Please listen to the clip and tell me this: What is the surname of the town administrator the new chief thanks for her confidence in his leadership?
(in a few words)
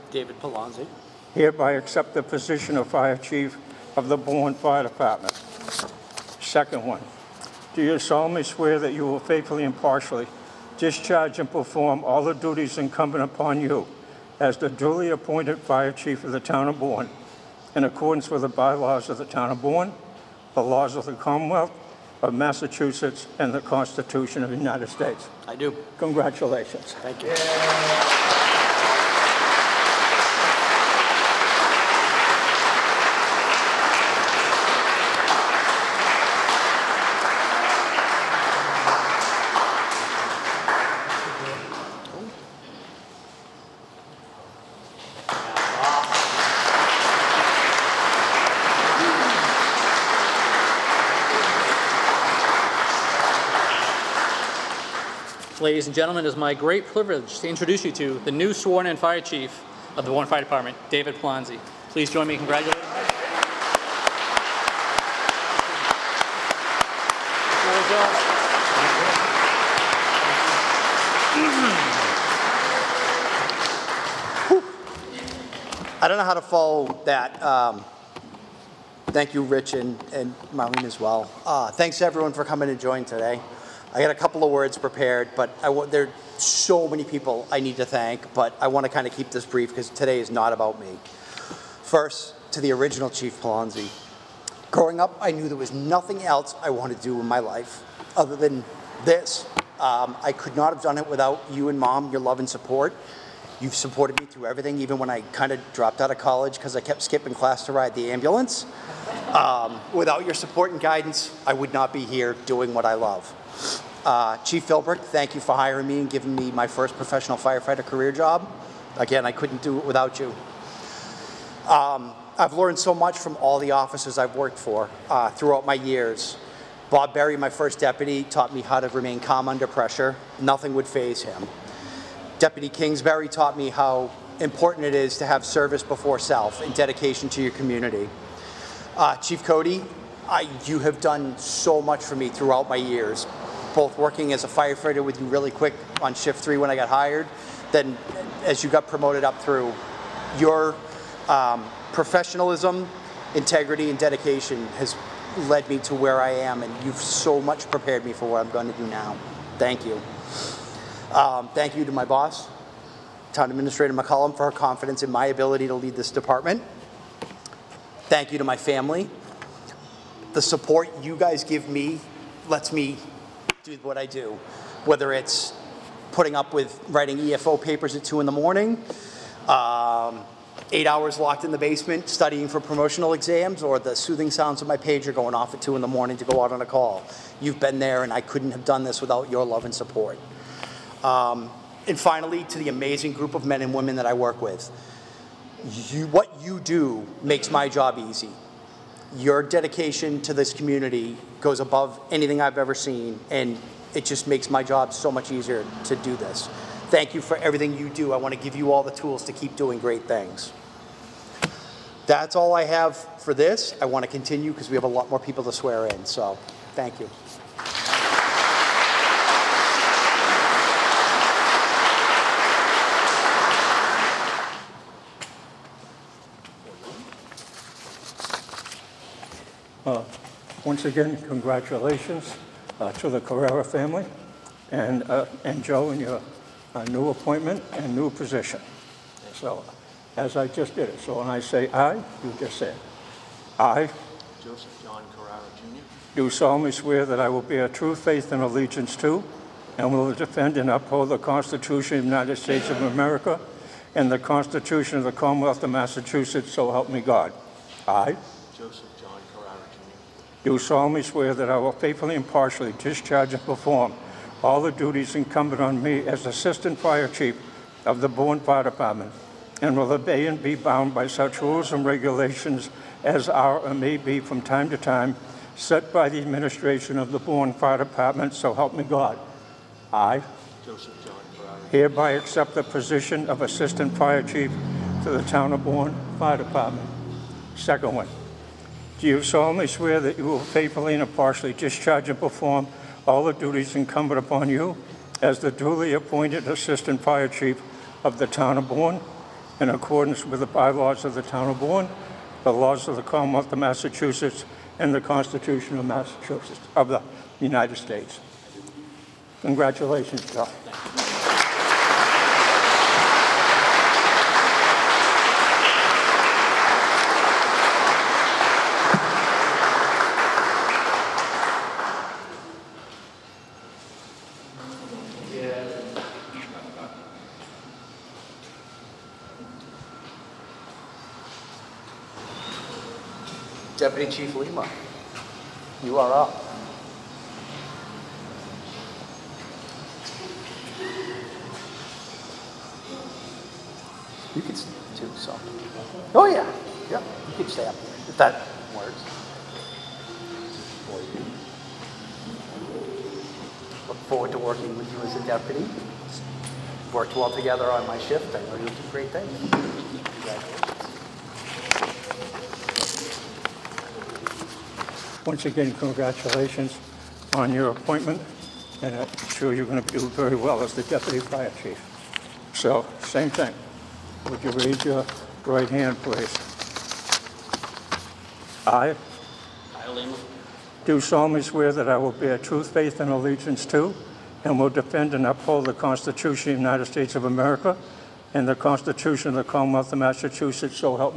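McCollum.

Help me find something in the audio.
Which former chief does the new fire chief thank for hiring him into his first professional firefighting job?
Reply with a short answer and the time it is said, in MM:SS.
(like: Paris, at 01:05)
Chief Philbrick, at 01:54.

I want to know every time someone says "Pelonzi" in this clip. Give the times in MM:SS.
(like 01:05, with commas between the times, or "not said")
00:00, 01:33.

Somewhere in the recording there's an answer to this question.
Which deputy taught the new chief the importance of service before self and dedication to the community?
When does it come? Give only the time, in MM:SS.
02:12.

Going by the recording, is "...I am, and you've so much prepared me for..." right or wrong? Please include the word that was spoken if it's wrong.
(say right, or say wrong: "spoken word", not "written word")
right.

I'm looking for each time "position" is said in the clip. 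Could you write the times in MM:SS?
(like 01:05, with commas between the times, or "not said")
00:02, 03:58, 04:42.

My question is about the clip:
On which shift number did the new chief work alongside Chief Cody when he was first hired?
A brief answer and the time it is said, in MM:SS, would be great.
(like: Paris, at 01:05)
3, at 02:26.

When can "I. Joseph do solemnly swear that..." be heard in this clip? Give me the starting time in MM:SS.
04:17.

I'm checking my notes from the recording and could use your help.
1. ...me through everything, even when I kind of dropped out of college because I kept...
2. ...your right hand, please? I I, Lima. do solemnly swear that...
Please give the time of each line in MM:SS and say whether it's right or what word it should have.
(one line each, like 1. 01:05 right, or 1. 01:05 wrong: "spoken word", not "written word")
1. 01:44 right
2. 06:14 right.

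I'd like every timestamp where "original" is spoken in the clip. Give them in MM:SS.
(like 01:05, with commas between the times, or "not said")
01:32.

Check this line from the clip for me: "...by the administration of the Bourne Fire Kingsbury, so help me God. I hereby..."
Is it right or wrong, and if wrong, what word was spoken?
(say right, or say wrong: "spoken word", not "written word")
wrong: "Department", not "Kingsbury".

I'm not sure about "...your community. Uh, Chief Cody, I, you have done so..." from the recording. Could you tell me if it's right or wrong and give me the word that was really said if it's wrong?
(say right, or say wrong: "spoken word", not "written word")
right.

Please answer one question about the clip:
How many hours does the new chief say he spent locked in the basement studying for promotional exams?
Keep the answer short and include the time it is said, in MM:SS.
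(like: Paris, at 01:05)
8, at 03:00.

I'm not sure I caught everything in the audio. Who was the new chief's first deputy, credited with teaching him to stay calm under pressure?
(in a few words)
Bob Berry.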